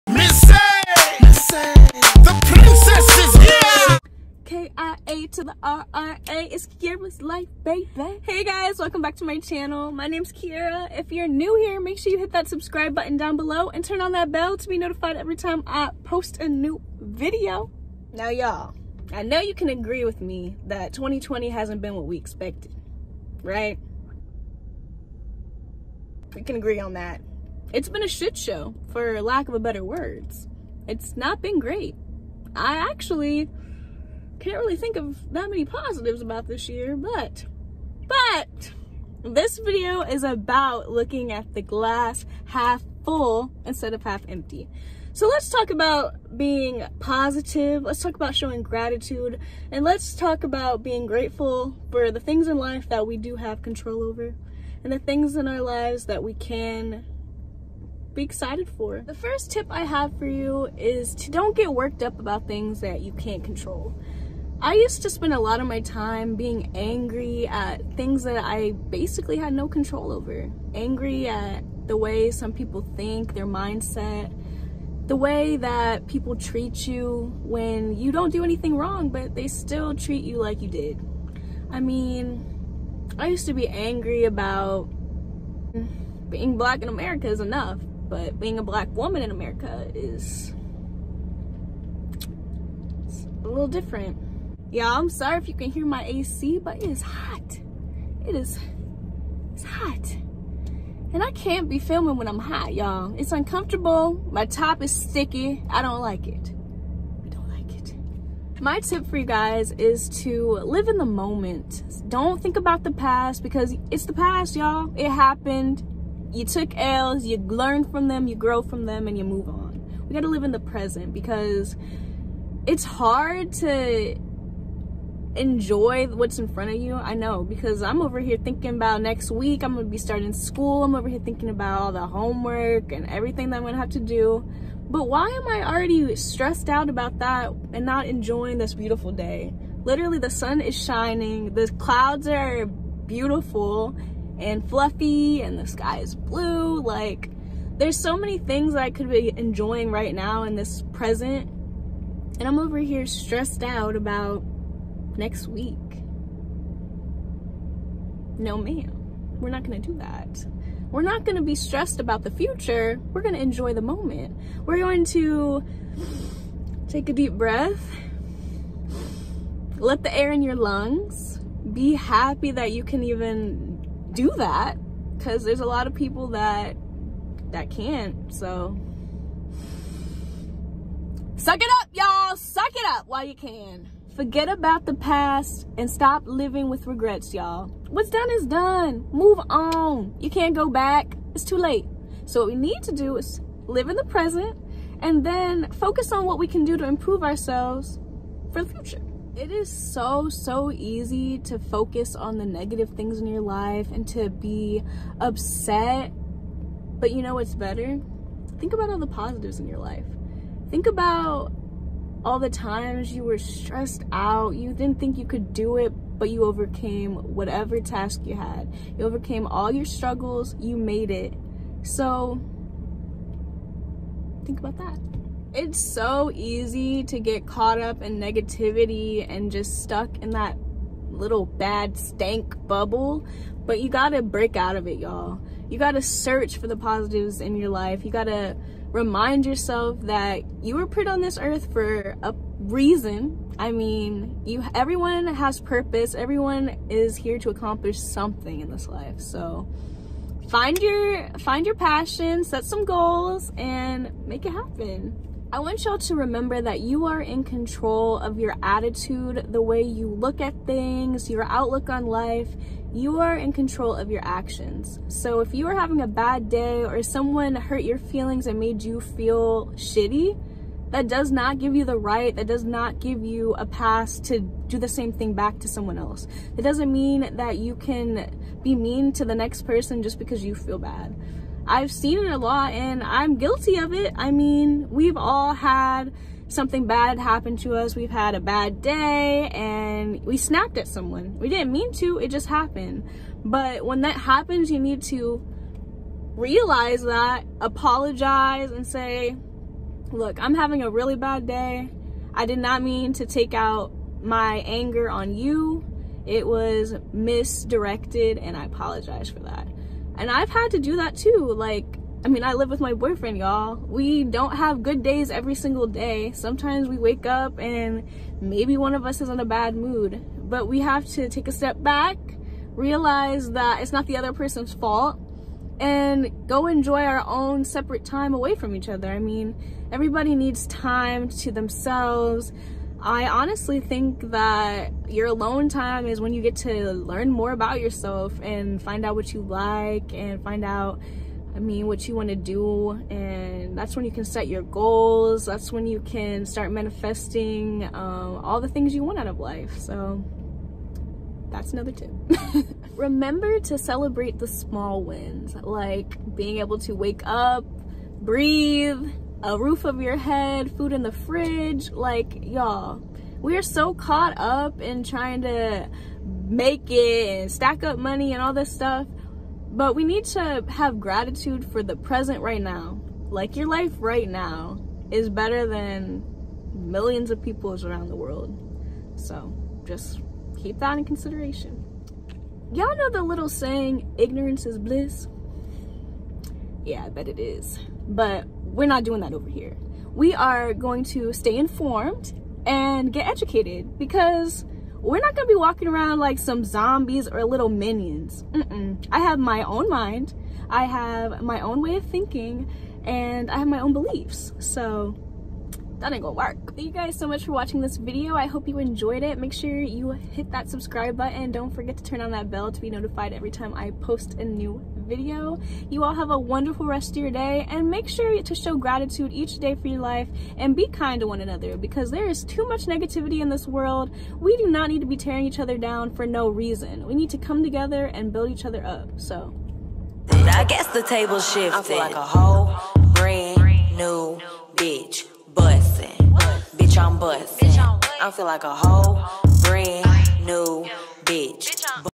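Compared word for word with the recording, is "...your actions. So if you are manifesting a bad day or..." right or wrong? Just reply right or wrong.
wrong.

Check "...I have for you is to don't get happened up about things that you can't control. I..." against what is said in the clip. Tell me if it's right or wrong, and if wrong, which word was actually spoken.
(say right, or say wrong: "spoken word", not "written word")
wrong: "worked", not "happened".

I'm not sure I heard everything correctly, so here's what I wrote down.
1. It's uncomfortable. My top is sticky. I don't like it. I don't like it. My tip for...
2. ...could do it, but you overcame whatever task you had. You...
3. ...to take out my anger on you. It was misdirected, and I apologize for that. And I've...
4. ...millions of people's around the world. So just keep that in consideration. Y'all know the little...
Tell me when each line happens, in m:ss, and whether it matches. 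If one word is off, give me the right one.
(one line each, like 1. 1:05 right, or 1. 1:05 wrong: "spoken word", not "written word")
1. 1:43 right
2. 3:35 right
3. 5:03 right
4. 6:16 right.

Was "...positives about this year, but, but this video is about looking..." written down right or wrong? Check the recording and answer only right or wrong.
right.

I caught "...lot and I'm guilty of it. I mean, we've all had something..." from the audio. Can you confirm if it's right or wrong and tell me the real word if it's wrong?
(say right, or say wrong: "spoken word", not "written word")
right.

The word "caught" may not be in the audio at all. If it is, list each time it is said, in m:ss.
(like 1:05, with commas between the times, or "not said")
3:47, 6:03.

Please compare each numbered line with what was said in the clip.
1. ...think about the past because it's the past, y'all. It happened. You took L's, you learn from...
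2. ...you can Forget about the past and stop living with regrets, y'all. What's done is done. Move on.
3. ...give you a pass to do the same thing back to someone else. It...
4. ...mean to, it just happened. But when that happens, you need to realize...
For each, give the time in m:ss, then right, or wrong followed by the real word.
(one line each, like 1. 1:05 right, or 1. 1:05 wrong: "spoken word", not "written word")
1. 1:52 right
2. 3:03 right
3. 4:32 right
4. 4:51 right.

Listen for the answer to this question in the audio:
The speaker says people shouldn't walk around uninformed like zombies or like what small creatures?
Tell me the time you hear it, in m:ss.
6:37.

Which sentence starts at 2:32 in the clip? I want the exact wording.
And I'm over here stressed out about next week.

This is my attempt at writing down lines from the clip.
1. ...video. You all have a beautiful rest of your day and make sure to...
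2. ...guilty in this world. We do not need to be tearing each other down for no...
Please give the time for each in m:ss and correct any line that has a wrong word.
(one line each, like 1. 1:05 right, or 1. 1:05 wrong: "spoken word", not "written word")
1. 6:55 wrong: "wonderful", not "beautiful"
2. 7:02 wrong: "negativity", not "guilty".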